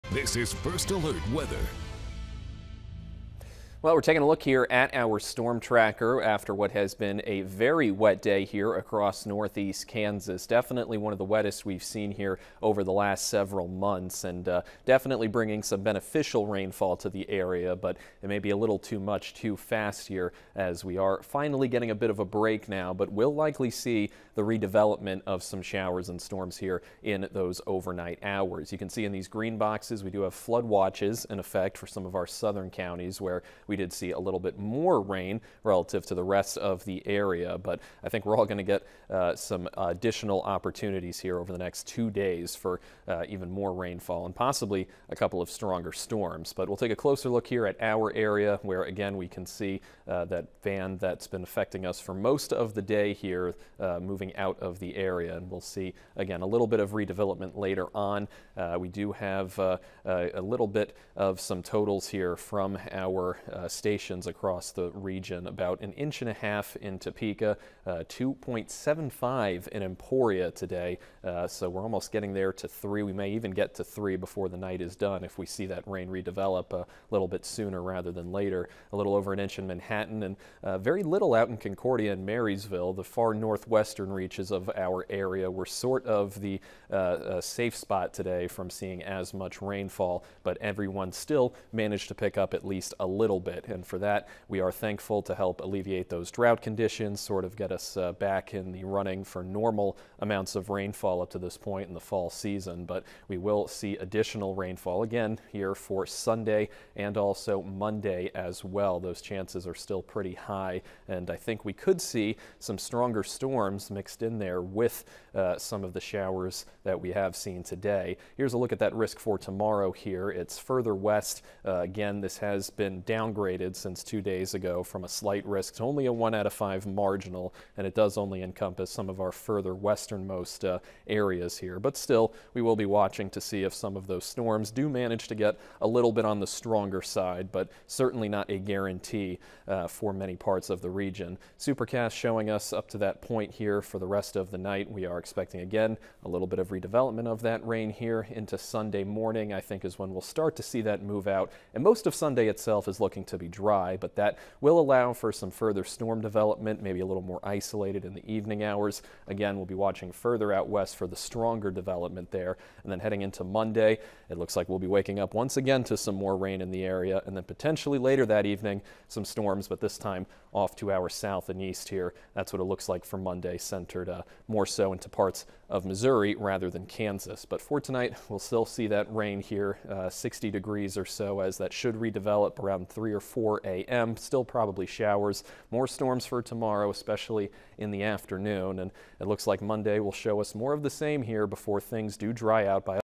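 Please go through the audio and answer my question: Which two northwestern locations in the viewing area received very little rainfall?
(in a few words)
Concordia and Marysville.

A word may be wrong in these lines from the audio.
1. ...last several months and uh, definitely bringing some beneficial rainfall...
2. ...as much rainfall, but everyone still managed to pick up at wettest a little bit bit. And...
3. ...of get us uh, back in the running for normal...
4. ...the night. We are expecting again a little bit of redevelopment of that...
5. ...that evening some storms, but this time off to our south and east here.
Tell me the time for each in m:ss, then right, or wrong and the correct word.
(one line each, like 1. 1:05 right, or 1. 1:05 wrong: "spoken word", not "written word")
1. 0:12 right
2. 1:29 wrong: "least", not "wettest"
3. 1:37 right
4. 2:24 right
5. 2:48 right.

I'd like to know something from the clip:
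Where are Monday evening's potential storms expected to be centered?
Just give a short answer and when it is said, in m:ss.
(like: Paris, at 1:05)
Missouri, at 2:55.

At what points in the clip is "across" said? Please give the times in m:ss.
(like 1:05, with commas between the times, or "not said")
0:08, 1:04.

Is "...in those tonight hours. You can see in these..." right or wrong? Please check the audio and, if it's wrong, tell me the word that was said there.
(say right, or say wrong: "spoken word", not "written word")
wrong: "overnight", not "tonight".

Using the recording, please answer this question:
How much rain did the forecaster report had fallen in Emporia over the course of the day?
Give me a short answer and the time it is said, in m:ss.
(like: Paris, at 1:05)
2.75 inches, at 1:08.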